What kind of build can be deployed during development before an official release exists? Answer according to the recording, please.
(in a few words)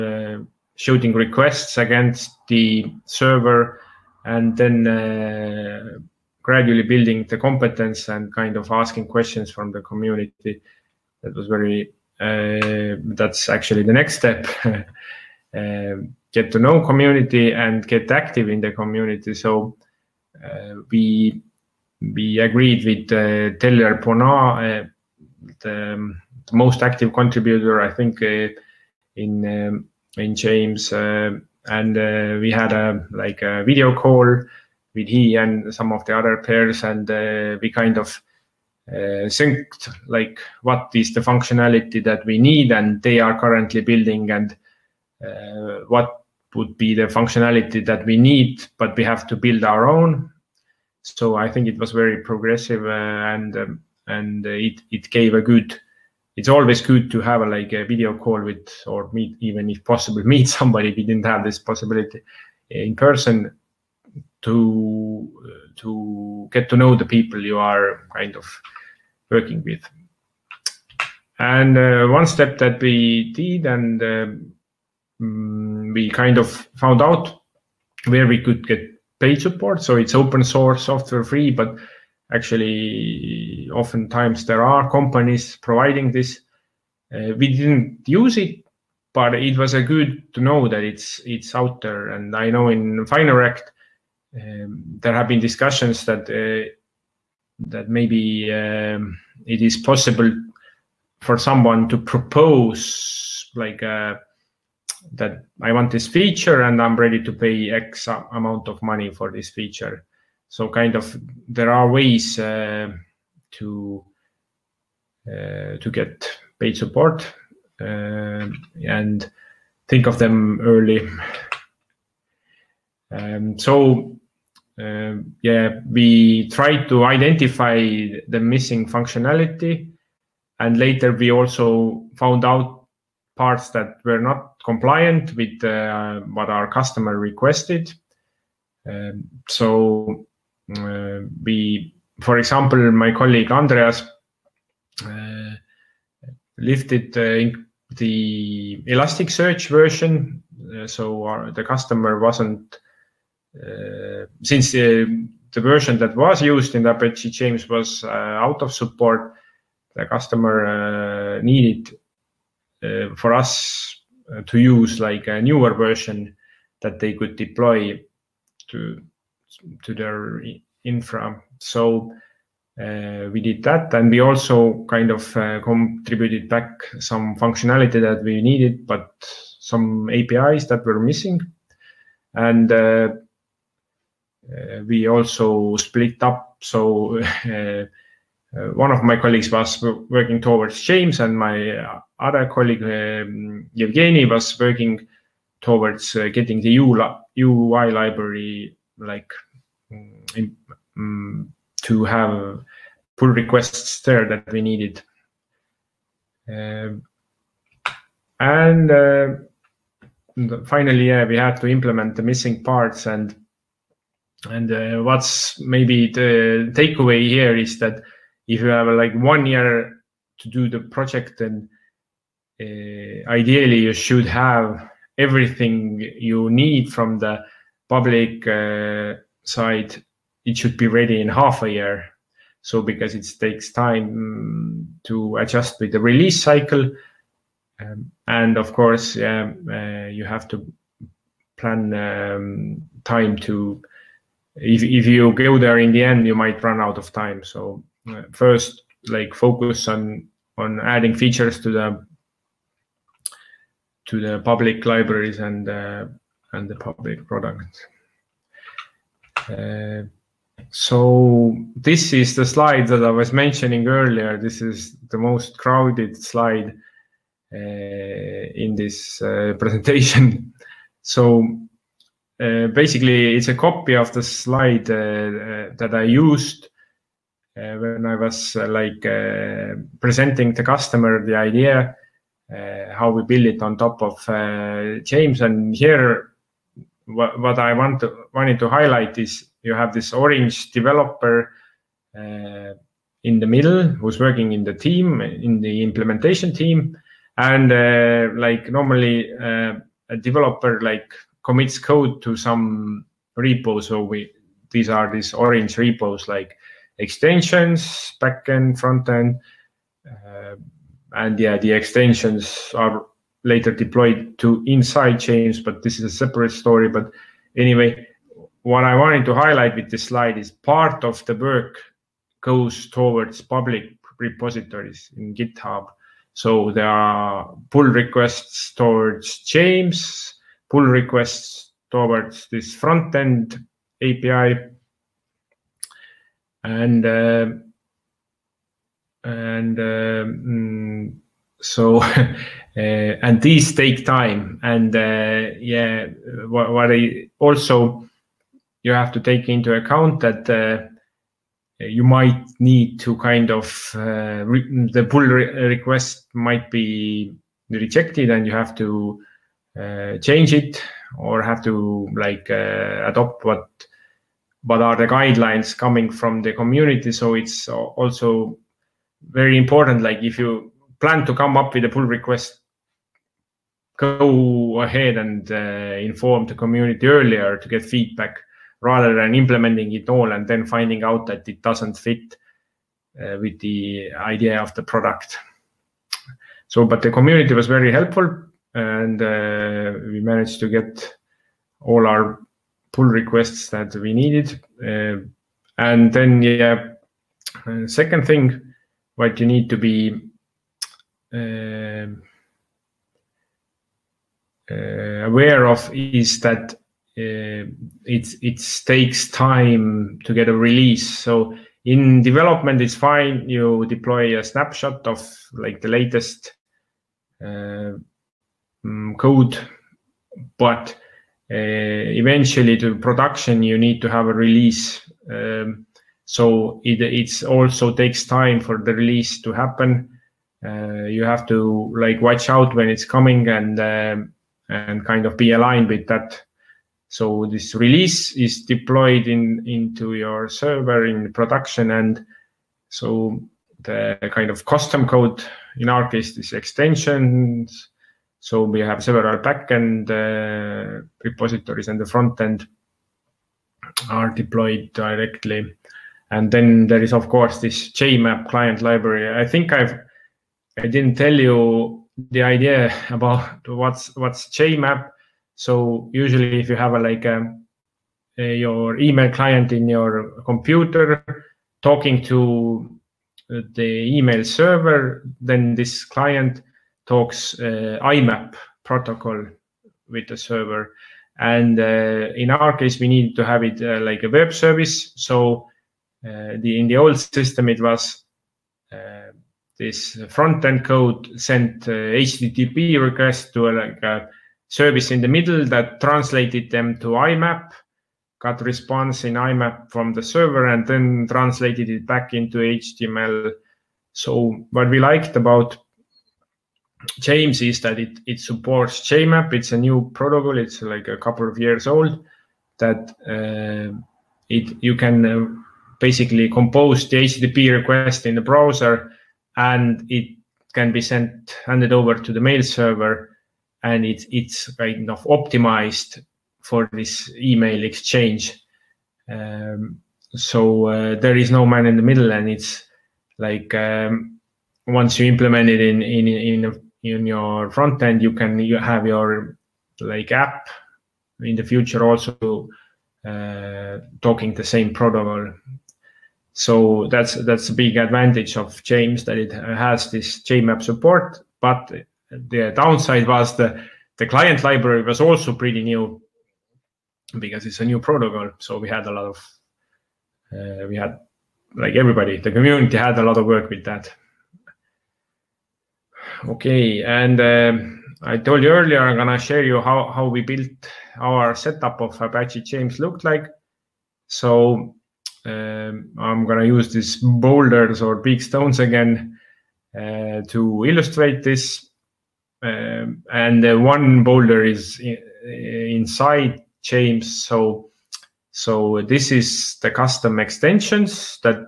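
snapshot.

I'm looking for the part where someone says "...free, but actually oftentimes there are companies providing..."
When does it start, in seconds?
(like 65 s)
81 s.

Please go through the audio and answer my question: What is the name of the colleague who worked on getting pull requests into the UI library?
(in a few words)
Evgeny.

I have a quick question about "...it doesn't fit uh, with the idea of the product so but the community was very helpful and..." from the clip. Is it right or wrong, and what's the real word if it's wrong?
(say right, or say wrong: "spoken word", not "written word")
right.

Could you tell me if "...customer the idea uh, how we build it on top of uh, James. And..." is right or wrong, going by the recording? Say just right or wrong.
right.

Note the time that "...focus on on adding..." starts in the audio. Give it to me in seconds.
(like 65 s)
249 s.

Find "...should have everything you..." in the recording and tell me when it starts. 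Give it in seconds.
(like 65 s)
223 s.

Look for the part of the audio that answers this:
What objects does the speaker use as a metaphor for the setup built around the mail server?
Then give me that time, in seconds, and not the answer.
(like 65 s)
577 s.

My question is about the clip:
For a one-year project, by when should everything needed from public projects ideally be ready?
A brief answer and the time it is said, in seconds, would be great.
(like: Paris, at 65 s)
half a year, at 231 s.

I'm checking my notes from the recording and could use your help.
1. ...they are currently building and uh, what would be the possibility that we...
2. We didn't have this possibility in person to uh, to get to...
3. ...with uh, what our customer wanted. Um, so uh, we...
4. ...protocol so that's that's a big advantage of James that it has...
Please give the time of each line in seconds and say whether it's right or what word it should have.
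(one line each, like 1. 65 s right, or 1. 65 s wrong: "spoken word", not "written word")
1. 43 s wrong: "functionality", not "possibility"
2. 60 s right
3. 135 s wrong: "requested", not "wanted"
4. 544 s right.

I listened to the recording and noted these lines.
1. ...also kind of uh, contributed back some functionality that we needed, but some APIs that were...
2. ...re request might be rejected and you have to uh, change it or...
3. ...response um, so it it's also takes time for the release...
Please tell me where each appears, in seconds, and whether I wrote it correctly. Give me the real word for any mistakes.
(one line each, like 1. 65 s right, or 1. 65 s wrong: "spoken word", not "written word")
1. 174 s right
2. 355 s right
3. 424 s wrong: "release", not "response".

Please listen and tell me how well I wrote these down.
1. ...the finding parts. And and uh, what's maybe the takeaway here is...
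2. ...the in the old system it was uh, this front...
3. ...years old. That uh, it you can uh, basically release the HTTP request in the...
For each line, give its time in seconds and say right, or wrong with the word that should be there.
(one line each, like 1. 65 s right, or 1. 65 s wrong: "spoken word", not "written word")
1. 212 s wrong: "missing", not "finding"
2. 486 s right
3. 511 s wrong: "compose", not "release".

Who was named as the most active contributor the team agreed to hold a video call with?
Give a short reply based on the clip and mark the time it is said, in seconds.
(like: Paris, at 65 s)
Tellier Benoit, at 23 s.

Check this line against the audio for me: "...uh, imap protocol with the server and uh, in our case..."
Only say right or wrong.
right.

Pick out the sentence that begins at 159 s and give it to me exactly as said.
The customer needed uh, for us uh, to use like a newer version that they could deploy to to their infra.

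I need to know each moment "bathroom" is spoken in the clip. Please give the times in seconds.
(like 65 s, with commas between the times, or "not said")
not said.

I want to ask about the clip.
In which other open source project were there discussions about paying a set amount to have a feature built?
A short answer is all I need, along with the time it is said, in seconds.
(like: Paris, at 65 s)
Fineract, at 93 s.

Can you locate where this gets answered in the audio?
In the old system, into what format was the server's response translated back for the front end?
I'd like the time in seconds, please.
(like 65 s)
502 s.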